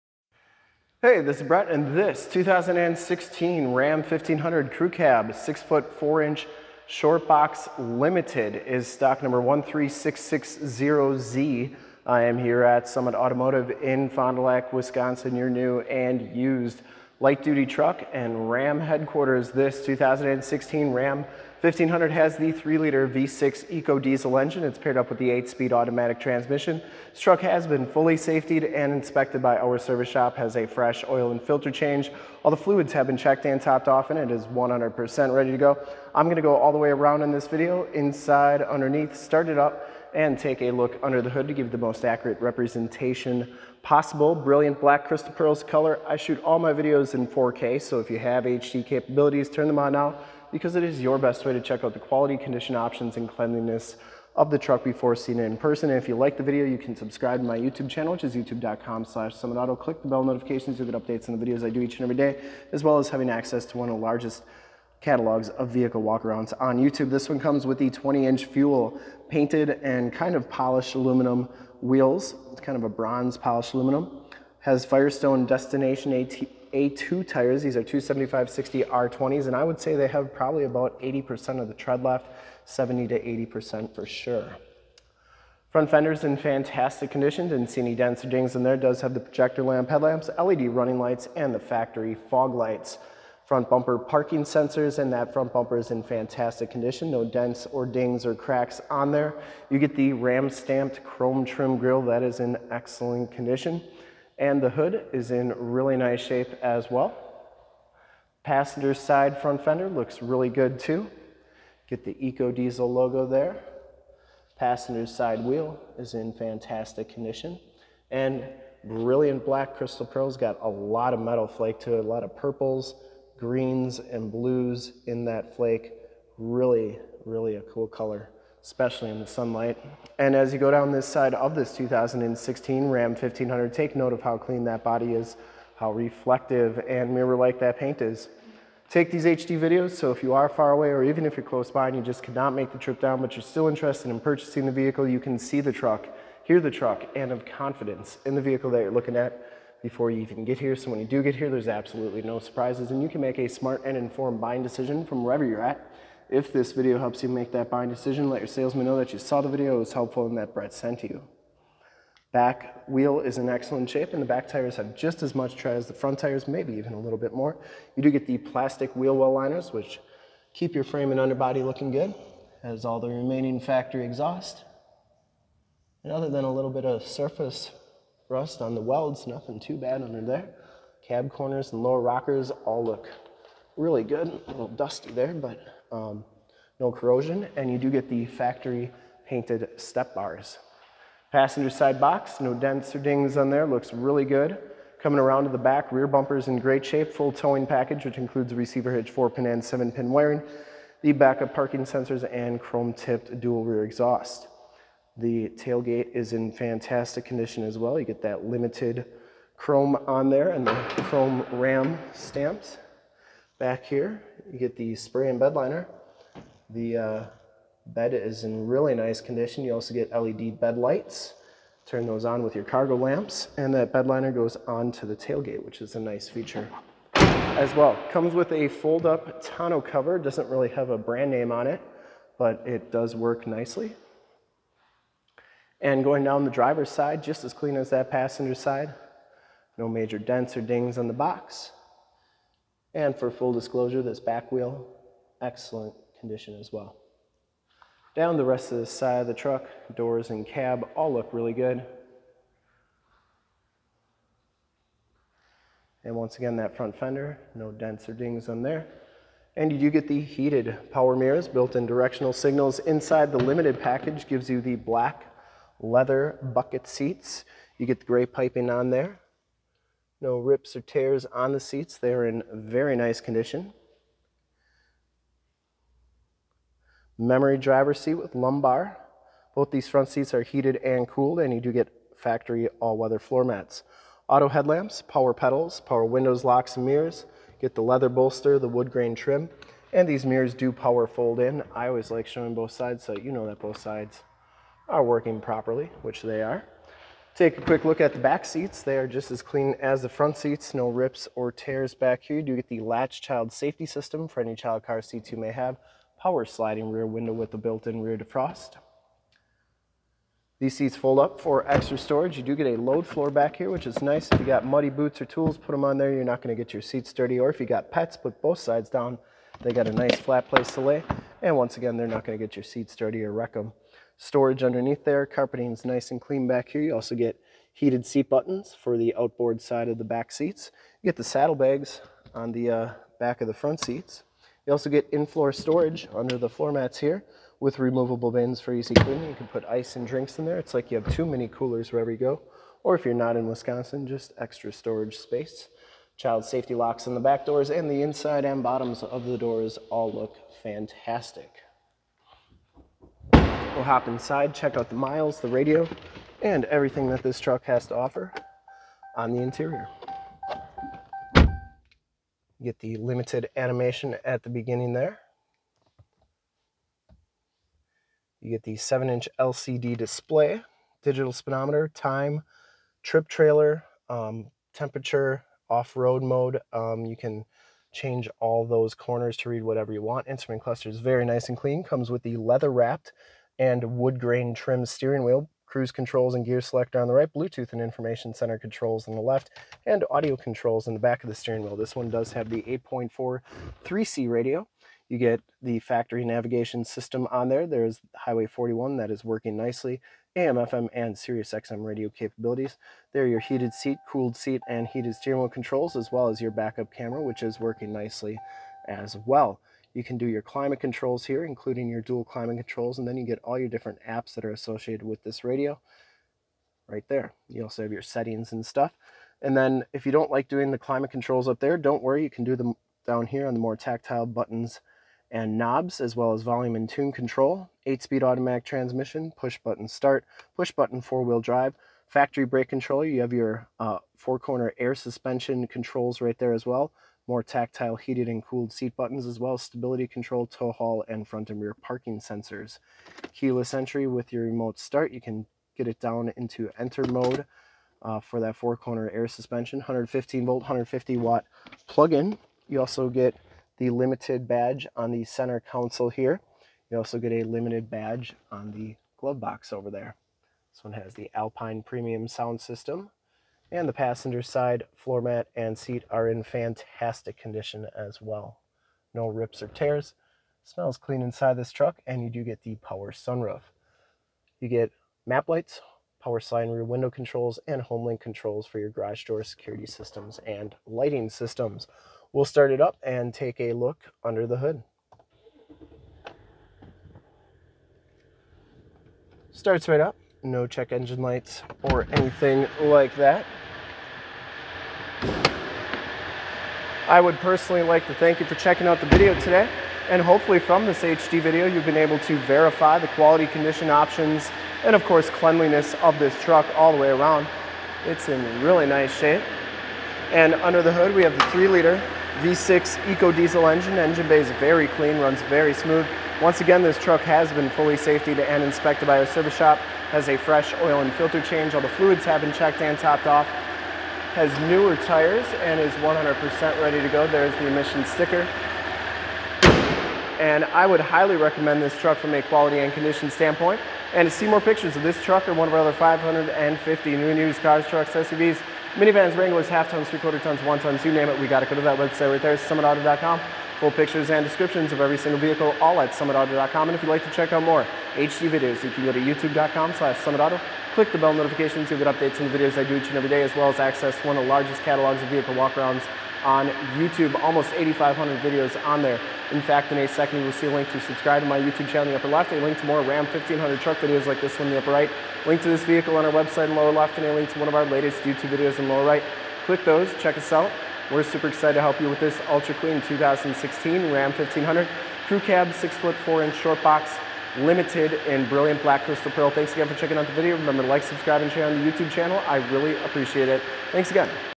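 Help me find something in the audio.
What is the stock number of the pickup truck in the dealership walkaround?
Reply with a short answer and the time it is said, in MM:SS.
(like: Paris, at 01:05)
13660Z, at 00:09.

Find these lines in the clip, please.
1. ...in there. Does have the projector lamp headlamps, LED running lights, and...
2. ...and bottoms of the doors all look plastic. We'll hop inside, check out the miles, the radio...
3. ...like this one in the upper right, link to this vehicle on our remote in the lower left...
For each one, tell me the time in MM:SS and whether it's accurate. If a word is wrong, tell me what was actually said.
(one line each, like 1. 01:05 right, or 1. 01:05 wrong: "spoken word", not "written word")
1. 01:28 right
2. 05:48 wrong: "fantastic", not "plastic"
3. 09:24 wrong: "website", not "remote".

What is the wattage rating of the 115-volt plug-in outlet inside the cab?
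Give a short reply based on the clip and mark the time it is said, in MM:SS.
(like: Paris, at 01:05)
150 watts, at 07:30.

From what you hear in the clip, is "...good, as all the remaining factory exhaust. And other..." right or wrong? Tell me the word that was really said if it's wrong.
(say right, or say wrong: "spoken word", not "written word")
right.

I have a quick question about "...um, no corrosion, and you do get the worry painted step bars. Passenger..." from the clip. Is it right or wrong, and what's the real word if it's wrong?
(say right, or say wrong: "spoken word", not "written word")
wrong: "factory", not "worry".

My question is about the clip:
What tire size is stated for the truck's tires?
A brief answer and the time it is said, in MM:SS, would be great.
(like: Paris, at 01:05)
275/60 R20, at 01:17.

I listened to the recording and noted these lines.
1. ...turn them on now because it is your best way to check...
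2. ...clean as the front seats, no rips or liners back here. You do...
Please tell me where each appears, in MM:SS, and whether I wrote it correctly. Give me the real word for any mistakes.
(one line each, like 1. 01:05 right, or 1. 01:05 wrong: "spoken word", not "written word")
1. 00:49 right
2. 04:59 wrong: "tears", not "liners".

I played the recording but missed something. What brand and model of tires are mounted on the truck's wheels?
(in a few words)
Firestone Destination AT2.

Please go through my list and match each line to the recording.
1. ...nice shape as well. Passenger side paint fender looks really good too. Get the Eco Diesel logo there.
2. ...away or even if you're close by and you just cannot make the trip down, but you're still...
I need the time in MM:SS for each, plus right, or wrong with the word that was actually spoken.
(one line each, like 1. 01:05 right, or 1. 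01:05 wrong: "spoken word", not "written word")
1. 01:45 wrong: "front", not "paint"
2. 02:20 right.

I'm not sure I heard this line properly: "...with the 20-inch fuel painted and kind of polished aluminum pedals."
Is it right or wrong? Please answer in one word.
wrong.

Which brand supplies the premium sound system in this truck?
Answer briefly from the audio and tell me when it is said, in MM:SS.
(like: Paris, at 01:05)
Alpine, at 07:41.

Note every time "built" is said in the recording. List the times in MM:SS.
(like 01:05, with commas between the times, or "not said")
04:21, 05:07.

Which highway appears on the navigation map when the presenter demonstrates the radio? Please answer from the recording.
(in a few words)
Highway 41.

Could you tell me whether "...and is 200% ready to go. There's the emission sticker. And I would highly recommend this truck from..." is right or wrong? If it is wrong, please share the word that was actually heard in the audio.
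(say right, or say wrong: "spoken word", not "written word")
wrong: "100", not "200".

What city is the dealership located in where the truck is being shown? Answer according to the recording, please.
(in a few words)
Fond du Lac.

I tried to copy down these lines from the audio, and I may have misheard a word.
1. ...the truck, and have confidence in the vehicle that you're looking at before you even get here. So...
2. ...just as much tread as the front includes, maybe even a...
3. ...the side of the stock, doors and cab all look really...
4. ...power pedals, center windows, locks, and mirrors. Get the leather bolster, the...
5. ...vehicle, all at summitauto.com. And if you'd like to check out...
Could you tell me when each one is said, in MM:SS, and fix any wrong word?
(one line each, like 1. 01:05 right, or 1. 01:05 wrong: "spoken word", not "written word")
1. 02:26 right
2. 02:44 wrong: "tires", not "includes"
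3. 04:08 wrong: "truck", not "stock"
4. 04:45 wrong: "power", not "center"
5. 09:05 right.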